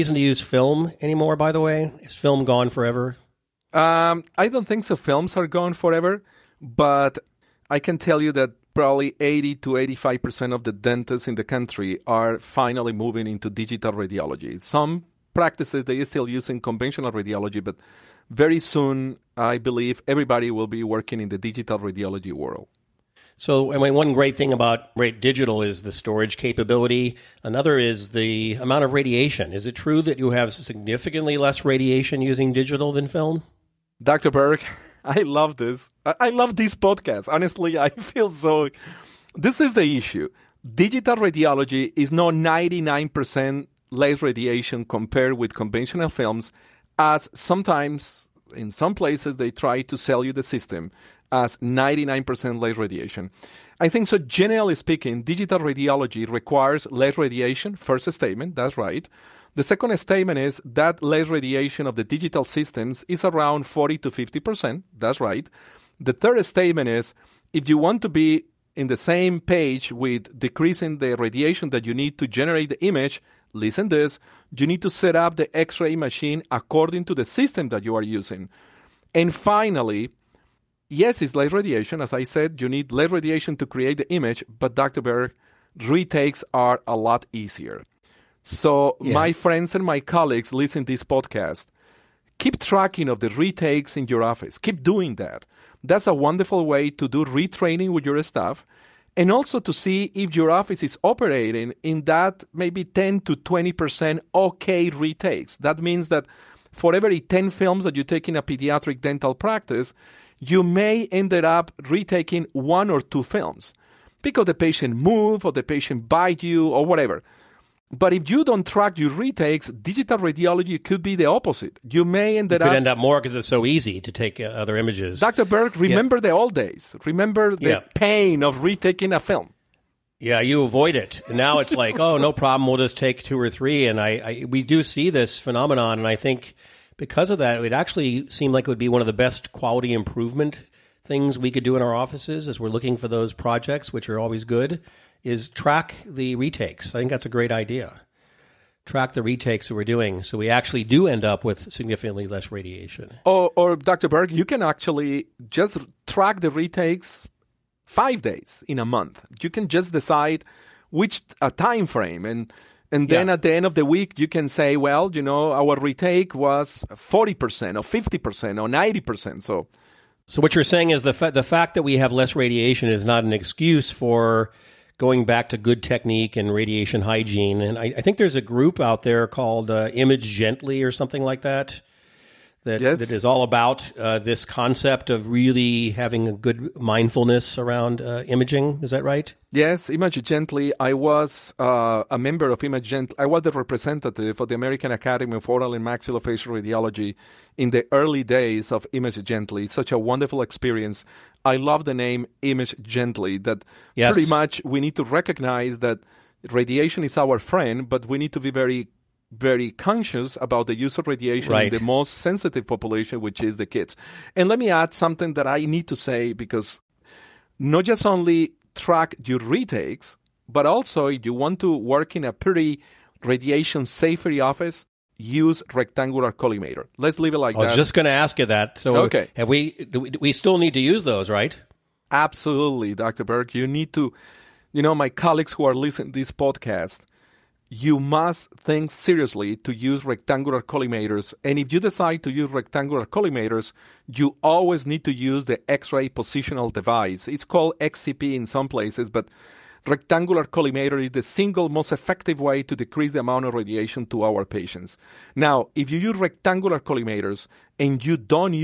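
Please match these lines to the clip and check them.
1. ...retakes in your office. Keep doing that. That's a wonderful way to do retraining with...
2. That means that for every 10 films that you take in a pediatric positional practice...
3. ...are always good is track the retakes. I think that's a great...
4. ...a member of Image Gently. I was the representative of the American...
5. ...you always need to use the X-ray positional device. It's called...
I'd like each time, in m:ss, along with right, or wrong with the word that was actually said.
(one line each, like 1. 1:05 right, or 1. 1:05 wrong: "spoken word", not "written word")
1. 1:33 right
2. 1:45 wrong: "dental", not "positional"
3. 2:24 right
4. 3:12 right
5. 4:04 right.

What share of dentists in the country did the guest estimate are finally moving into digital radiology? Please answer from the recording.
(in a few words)
80 to 85%.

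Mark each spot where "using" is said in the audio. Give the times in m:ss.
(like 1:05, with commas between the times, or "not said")
0:16, 0:32, 1:18.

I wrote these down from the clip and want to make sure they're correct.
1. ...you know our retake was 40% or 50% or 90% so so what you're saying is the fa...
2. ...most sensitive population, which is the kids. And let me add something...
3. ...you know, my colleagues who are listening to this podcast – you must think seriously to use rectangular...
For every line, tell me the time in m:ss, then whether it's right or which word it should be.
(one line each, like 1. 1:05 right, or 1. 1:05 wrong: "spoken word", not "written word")
1. 2:45 right
2. 3:31 right
3. 3:54 right.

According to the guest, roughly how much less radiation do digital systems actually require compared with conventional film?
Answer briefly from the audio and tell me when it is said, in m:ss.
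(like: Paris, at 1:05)
40 to 50%, at 1:03.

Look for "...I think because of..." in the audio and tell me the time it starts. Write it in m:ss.
2:16.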